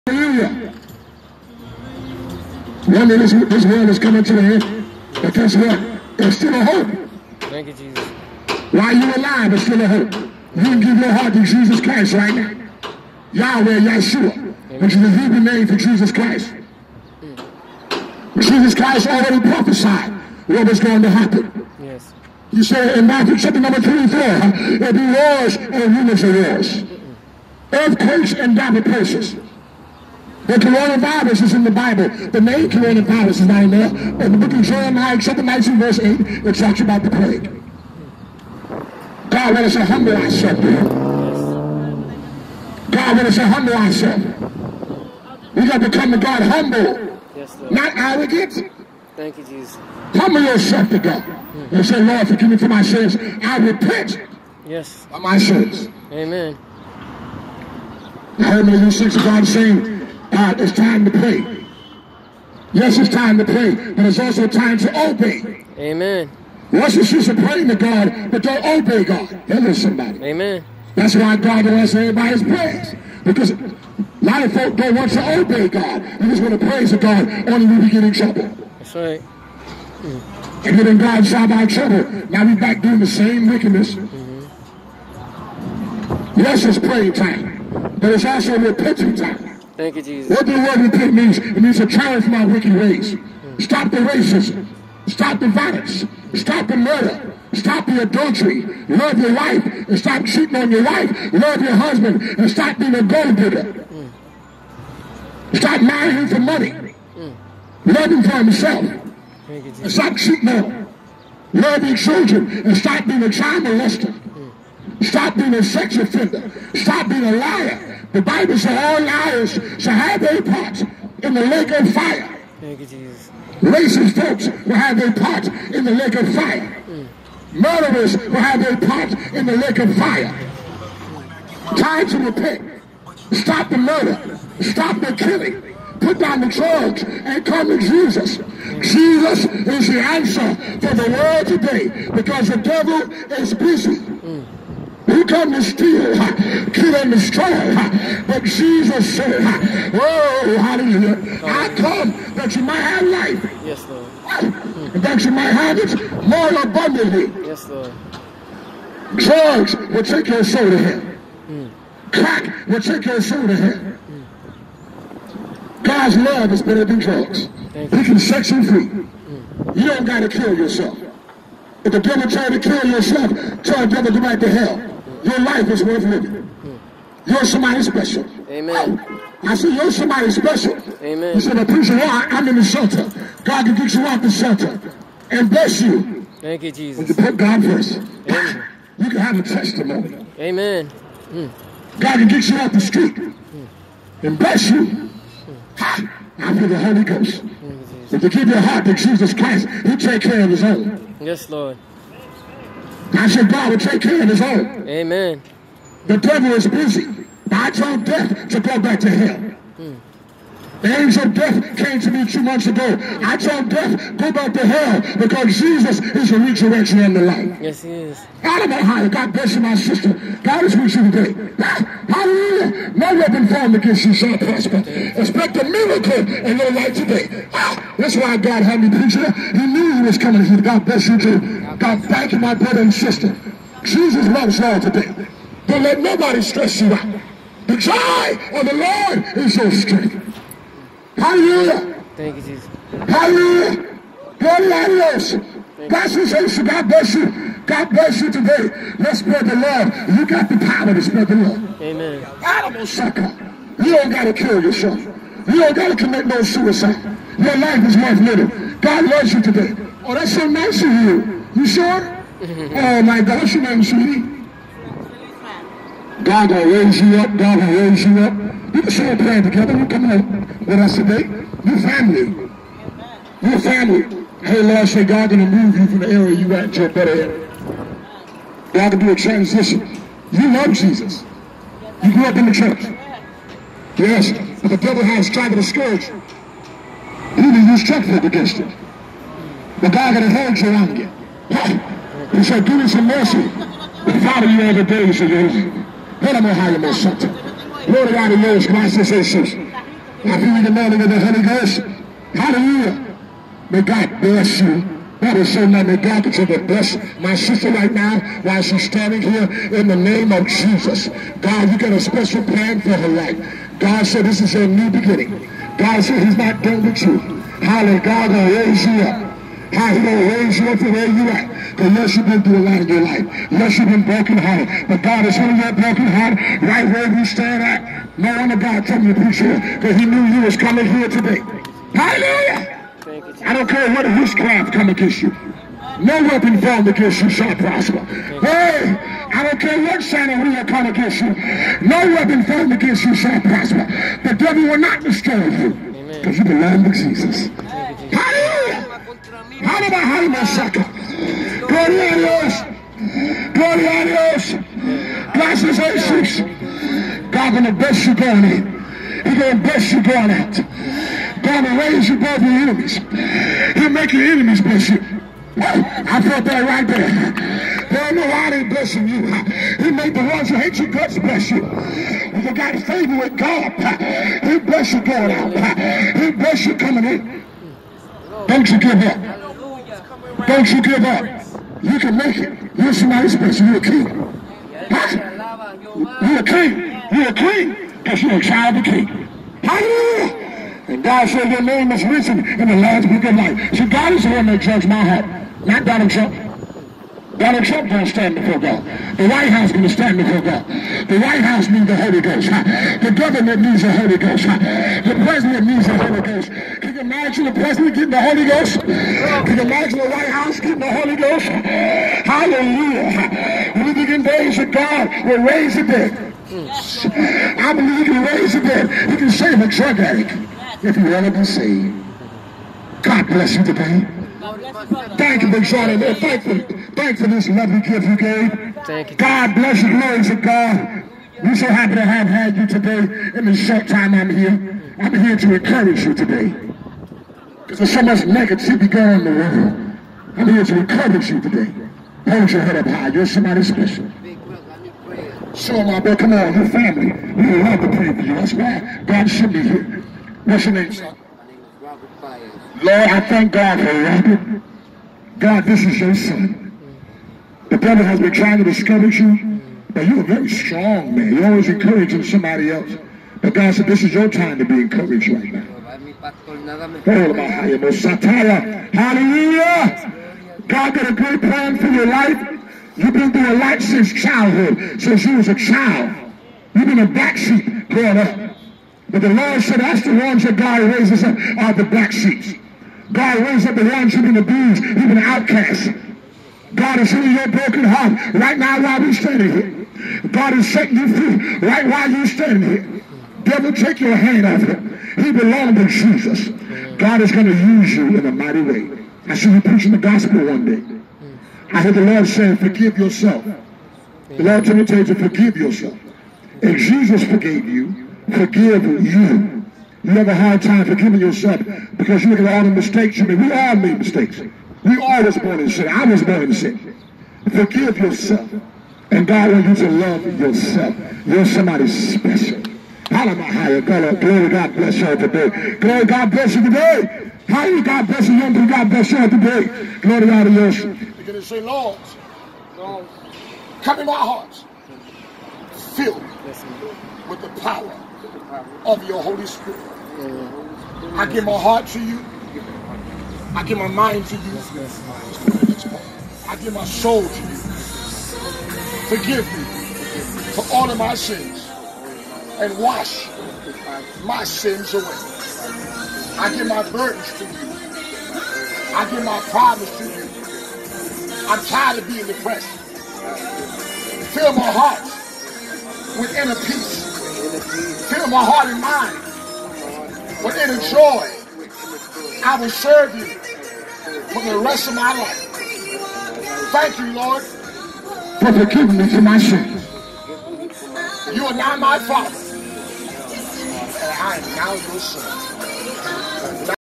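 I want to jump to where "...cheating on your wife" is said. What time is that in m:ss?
1:40.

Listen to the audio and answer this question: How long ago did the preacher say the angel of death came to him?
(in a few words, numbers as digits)
2 months.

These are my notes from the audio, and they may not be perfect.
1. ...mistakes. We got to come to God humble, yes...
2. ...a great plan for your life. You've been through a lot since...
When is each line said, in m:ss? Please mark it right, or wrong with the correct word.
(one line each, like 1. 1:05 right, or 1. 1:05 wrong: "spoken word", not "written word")
1. 0:43 wrong: "ourselves", not "mistakes"
2. 7:51 right.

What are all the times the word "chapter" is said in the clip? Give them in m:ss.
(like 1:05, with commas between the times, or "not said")
0:23, 0:35.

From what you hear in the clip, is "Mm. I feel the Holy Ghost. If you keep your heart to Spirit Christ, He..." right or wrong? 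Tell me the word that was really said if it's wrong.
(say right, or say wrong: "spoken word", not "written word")
wrong: "Jesus", not "Spirit".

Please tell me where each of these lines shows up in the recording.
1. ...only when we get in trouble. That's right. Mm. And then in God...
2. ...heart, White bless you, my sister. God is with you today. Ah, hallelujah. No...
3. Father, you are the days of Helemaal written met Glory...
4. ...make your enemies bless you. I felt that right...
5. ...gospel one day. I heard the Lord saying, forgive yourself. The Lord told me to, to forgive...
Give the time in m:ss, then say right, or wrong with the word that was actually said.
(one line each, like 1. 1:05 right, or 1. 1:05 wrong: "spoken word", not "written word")
1. 1:17 right
2. 3:38 wrong: "God", not "White"
3. 4:54 wrong: "haaien", not "written"
4. 6:03 right
5. 8:19 right.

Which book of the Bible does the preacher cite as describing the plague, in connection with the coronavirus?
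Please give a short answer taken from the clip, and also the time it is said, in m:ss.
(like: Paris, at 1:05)
Jeremiah, at 0:34.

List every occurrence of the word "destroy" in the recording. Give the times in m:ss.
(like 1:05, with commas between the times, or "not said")
2:27, 5:45.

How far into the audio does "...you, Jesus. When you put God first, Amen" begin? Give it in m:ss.
3:06.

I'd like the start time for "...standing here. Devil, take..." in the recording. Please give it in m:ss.
8:12.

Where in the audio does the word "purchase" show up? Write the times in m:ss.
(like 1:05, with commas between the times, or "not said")
not said.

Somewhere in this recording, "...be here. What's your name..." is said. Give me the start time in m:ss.
7:29.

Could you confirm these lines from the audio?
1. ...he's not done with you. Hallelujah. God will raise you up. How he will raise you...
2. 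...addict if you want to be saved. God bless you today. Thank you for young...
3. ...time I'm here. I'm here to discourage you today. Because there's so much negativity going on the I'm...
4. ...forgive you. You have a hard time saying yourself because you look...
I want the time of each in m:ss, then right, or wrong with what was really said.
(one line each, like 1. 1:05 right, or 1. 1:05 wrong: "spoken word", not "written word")
1. 5:16 right
2. 6:59 wrong: "joining", not "young"
3. 7:13 wrong: "encourage", not "discourage"
4. 8:28 wrong: "forgiving", not "saying".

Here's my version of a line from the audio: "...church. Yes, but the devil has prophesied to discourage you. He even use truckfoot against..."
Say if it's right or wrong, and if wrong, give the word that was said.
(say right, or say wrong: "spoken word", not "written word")
wrong: "tried", not "prophesied".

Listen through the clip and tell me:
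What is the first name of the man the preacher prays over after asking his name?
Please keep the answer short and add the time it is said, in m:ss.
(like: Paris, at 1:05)
Robert, at 7:34.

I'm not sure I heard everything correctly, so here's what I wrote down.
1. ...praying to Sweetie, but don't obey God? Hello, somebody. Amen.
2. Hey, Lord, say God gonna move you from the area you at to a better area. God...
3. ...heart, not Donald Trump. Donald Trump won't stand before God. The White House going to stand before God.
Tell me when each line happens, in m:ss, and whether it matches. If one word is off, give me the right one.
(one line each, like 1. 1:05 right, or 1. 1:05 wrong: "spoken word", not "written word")
1. 1:07 wrong: "God", not "Sweetie"
2. 4:34 right
3. 6:35 right.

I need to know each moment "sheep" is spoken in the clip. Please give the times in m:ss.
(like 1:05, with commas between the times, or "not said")
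7:57, 8:02.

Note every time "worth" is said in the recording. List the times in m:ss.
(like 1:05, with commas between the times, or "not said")
2:55, 4:17.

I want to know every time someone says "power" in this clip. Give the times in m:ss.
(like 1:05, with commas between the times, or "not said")
4:10, 8:57.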